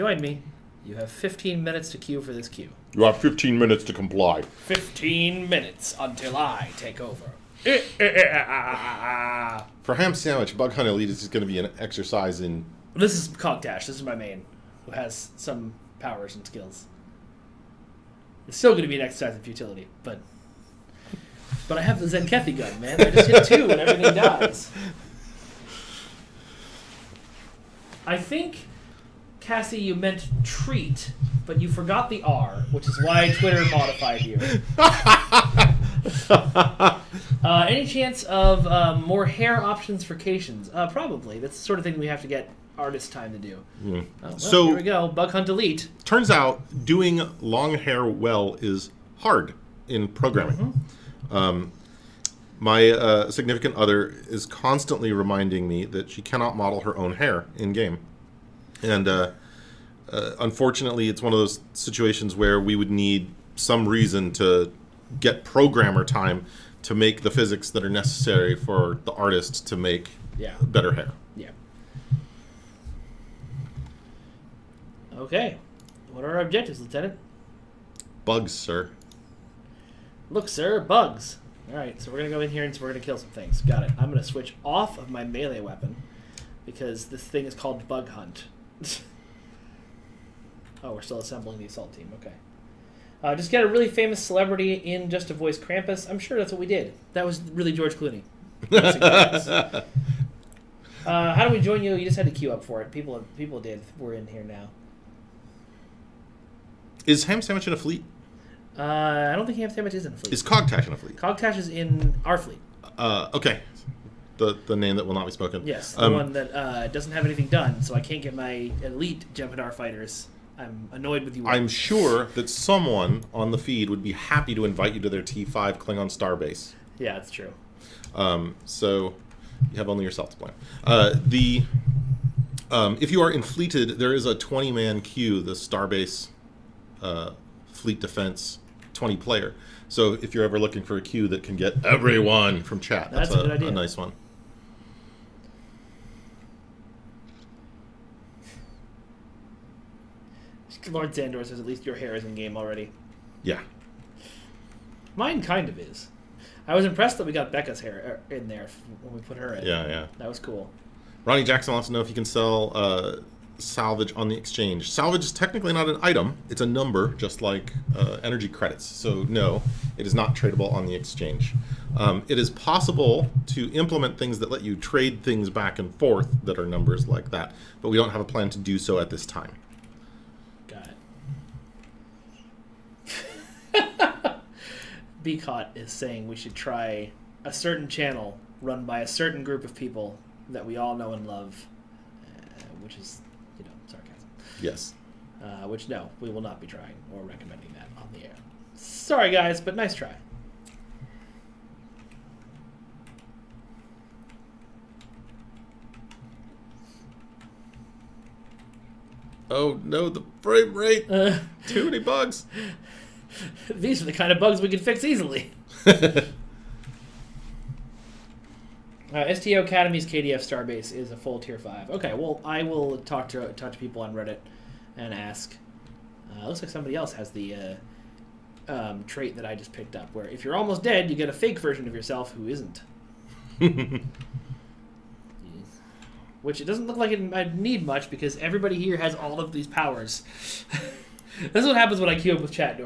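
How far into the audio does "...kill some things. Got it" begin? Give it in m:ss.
1:23.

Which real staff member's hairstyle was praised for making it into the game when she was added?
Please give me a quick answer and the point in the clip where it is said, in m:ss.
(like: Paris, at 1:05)
Becca, at 2:37.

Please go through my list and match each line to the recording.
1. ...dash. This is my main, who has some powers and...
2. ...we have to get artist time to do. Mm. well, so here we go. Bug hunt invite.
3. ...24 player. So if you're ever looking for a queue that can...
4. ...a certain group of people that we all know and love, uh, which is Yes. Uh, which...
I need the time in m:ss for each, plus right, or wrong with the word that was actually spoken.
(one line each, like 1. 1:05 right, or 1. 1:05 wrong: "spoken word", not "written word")
1. 0:13 right
2. 0:41 wrong: "delete", not "invite"
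3. 2:19 wrong: "20", not "24"
4. 3:08 right.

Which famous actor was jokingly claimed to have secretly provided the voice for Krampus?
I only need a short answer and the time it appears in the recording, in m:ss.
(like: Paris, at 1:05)
George Clooney, at 1:37.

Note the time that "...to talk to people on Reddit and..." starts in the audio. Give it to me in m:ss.
3:43.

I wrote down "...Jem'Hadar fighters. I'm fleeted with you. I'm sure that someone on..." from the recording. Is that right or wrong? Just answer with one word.
wrong.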